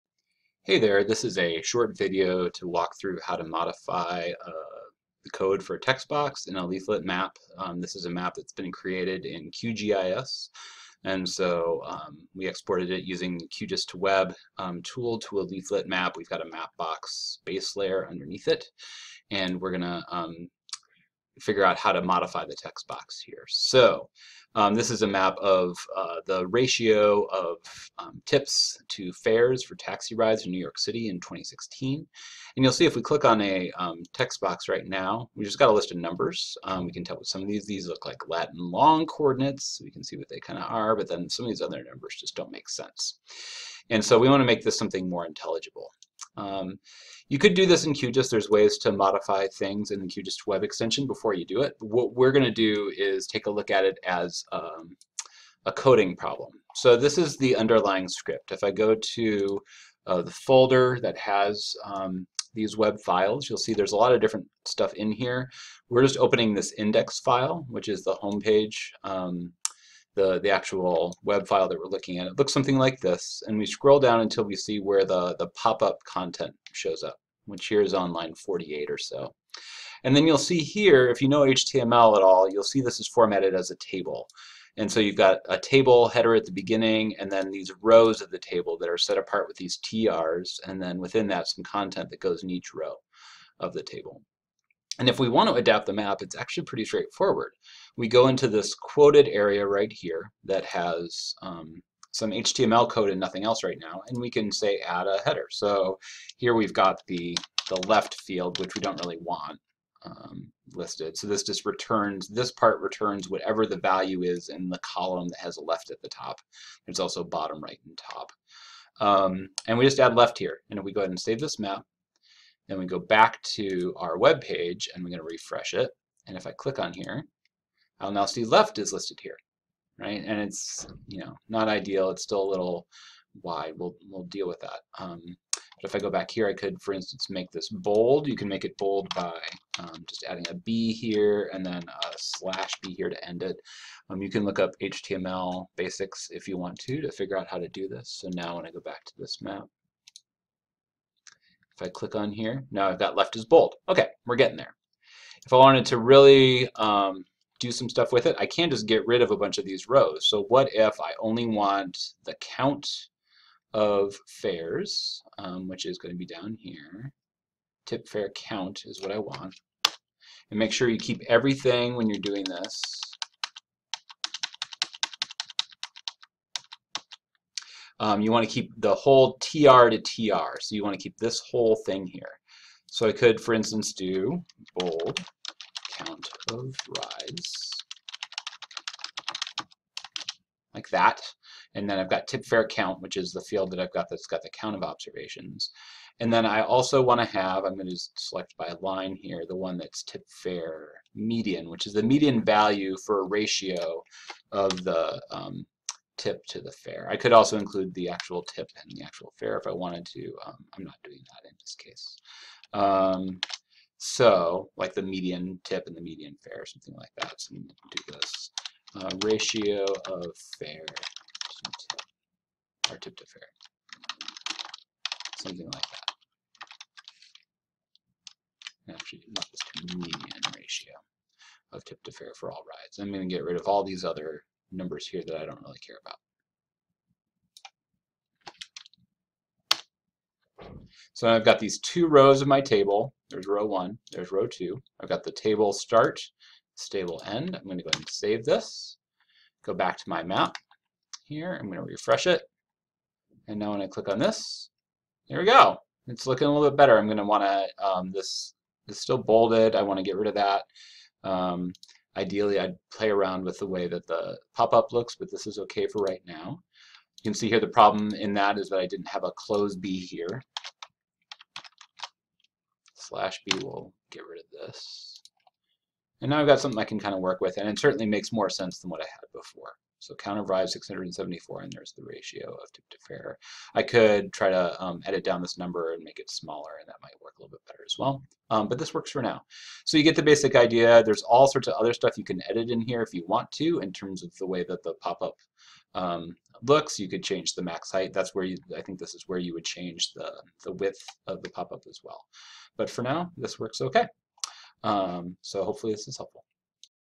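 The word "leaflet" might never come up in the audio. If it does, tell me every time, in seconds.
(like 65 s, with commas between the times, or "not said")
6 s, 15 s.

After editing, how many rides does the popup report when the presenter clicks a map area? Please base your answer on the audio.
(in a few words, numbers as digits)
674.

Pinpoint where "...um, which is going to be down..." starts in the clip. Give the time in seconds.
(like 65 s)
165 s.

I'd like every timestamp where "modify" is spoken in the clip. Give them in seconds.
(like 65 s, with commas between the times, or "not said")
3 s, 22 s, 48 s.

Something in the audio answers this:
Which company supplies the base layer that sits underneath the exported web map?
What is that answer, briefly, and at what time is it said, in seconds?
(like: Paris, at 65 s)
Mapbox, at 16 s.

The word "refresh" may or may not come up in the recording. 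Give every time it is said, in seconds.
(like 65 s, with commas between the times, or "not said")
125 s, 251 s.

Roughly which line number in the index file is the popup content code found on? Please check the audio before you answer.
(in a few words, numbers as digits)
48.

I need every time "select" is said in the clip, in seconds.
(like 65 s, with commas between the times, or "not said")
198 s.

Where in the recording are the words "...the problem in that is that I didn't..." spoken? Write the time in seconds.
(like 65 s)
267 s.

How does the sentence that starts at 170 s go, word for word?
And make sure you keep everything when you're doing this Um, you want to keep the whole TR to TR.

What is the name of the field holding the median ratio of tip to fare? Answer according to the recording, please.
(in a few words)
tip fare median.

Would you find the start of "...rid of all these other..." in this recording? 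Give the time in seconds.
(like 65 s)
233 s.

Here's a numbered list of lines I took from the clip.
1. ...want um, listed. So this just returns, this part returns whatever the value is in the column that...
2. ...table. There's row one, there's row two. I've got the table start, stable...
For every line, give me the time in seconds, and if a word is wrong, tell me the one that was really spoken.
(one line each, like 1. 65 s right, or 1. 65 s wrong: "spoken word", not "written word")
1. 109 s right
2. 242 s right.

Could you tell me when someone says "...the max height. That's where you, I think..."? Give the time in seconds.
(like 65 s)
297 s.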